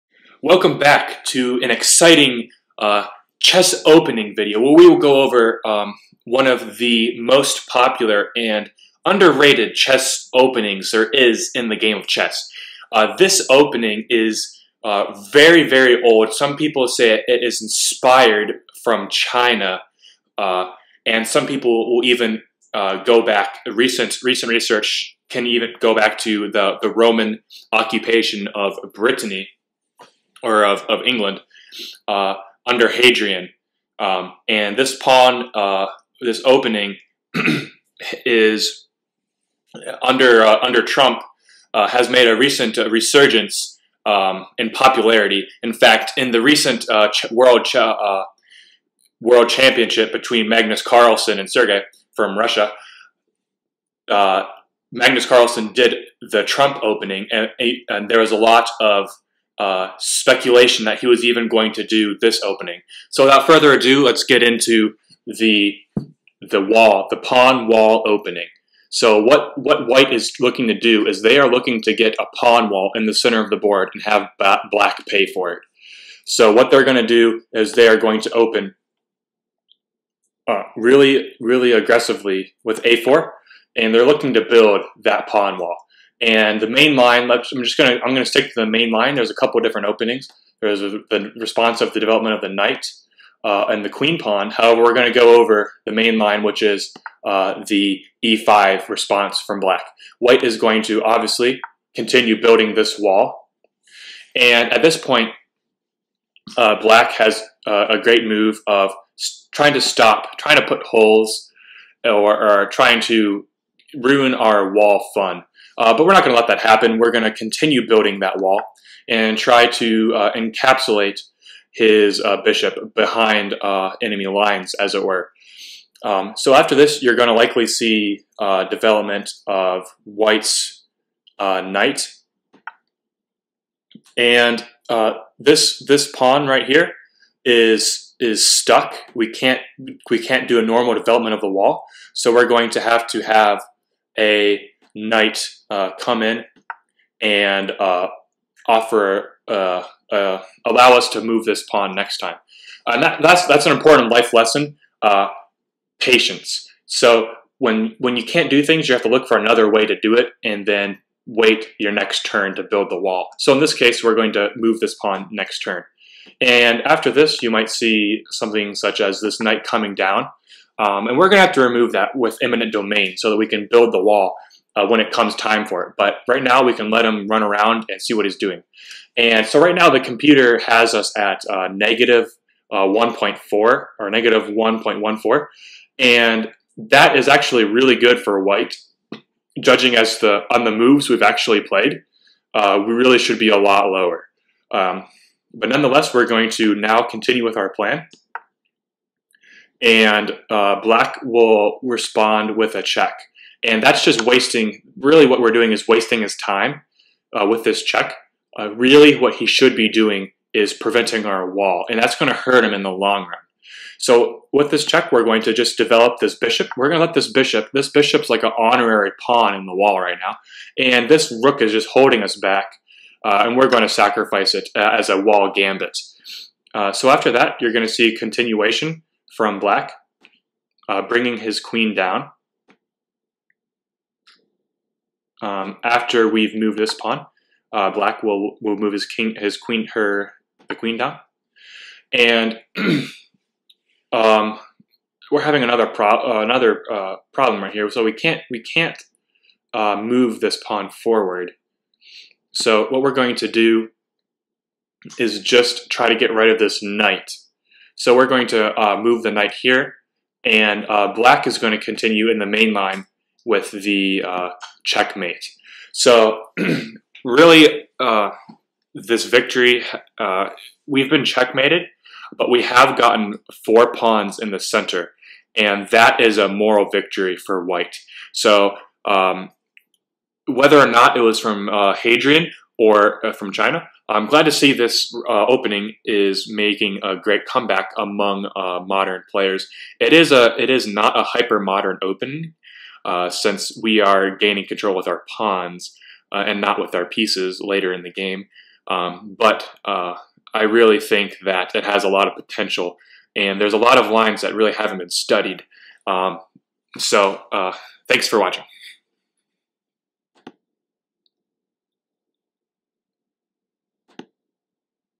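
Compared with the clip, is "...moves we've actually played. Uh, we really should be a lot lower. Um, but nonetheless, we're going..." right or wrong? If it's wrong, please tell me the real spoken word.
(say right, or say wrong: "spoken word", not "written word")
right.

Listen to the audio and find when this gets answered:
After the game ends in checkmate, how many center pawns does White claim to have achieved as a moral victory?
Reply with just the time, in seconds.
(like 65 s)
273 s.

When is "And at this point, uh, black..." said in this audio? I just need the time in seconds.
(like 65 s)
104 s.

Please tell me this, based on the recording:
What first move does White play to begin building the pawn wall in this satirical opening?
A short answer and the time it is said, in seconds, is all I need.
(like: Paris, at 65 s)
a4, at 82 s.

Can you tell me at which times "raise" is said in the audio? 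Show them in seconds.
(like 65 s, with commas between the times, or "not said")
not said.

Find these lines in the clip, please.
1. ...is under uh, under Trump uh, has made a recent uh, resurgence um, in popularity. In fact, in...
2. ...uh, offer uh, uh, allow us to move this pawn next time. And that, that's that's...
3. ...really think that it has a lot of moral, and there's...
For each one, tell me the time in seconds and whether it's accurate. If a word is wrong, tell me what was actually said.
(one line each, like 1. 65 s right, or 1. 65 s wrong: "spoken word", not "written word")
1. 38 s right
2. 147 s right
3. 300 s wrong: "potential", not "moral".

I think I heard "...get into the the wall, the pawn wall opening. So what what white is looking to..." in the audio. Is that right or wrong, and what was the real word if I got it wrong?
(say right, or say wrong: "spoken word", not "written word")
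right.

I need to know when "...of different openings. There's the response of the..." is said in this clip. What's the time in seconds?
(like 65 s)
89 s.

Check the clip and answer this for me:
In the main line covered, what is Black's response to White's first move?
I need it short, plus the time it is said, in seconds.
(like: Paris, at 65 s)
e5, at 98 s.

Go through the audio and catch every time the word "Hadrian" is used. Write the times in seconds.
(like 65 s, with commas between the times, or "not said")
32 s, 281 s.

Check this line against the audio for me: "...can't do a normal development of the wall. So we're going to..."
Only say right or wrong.
right.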